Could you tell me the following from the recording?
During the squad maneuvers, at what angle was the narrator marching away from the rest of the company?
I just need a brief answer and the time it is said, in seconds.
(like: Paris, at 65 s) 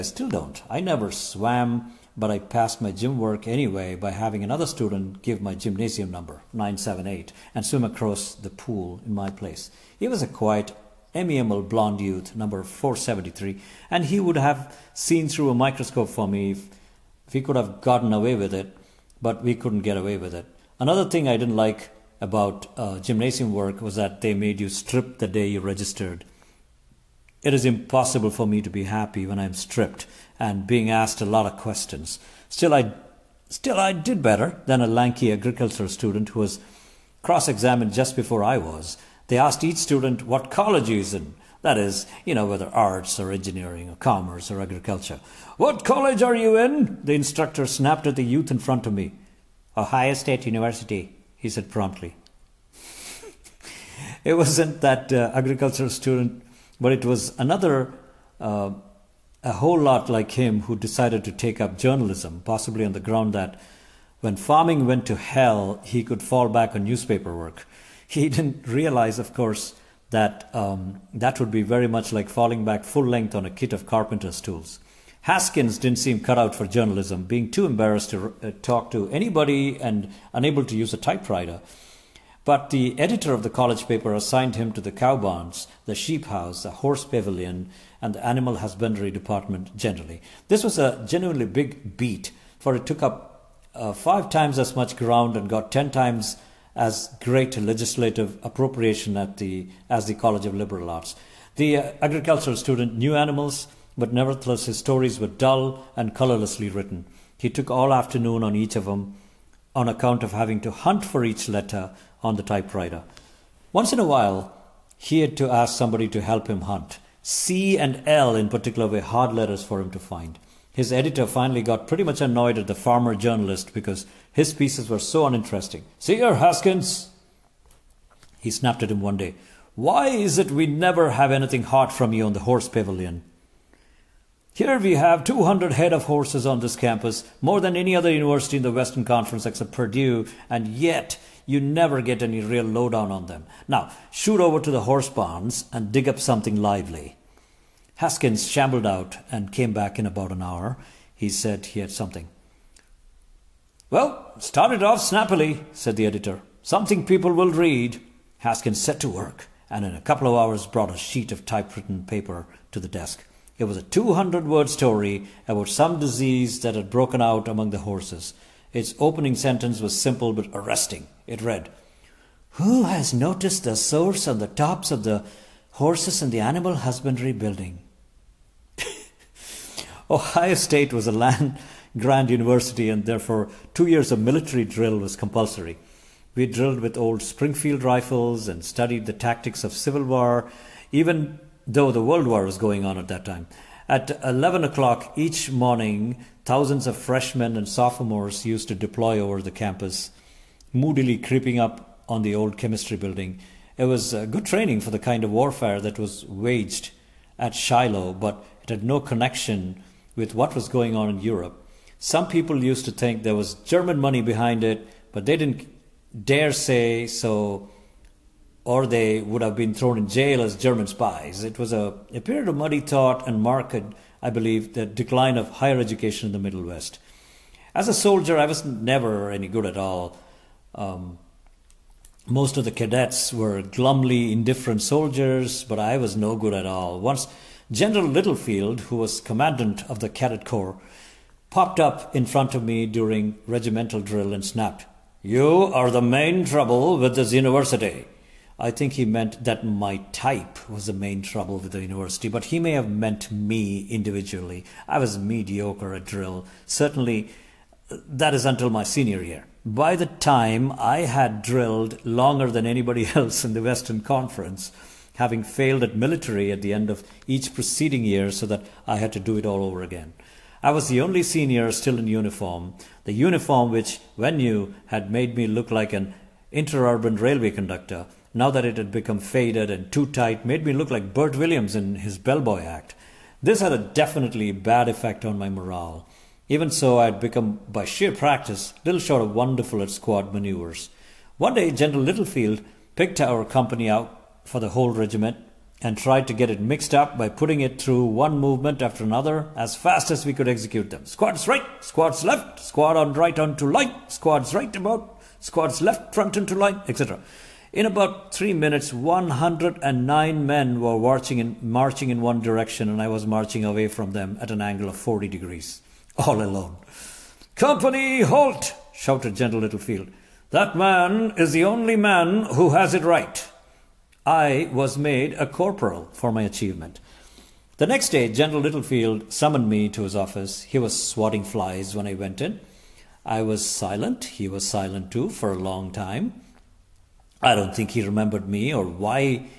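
40 degrees, at 314 s.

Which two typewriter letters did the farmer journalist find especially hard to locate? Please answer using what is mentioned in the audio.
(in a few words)
C and L.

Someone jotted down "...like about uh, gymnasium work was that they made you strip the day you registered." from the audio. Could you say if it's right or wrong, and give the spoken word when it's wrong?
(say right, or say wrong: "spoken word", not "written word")
right.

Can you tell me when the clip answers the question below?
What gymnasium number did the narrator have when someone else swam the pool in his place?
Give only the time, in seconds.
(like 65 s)
6 s.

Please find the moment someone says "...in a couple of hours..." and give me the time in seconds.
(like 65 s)
159 s.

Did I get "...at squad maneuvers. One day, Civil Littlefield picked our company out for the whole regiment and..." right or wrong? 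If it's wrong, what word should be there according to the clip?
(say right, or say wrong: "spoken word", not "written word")
wrong: "General", not "Civil".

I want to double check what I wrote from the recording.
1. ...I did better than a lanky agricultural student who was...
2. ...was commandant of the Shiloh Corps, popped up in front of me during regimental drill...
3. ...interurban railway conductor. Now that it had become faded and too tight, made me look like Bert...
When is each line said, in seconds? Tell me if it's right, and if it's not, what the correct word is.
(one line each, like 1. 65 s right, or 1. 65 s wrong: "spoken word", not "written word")
1. 33 s right
2. 238 s wrong: "Cadet", not "Shiloh"
3. 276 s right.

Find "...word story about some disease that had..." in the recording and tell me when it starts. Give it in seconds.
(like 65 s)
164 s.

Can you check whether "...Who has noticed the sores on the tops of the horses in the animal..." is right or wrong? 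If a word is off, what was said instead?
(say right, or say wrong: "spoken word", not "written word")
right.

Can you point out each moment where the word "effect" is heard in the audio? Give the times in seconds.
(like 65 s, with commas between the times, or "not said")
284 s.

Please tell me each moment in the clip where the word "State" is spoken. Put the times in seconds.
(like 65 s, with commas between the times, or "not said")
50 s, 180 s.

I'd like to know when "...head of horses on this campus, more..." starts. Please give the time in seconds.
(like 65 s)
135 s.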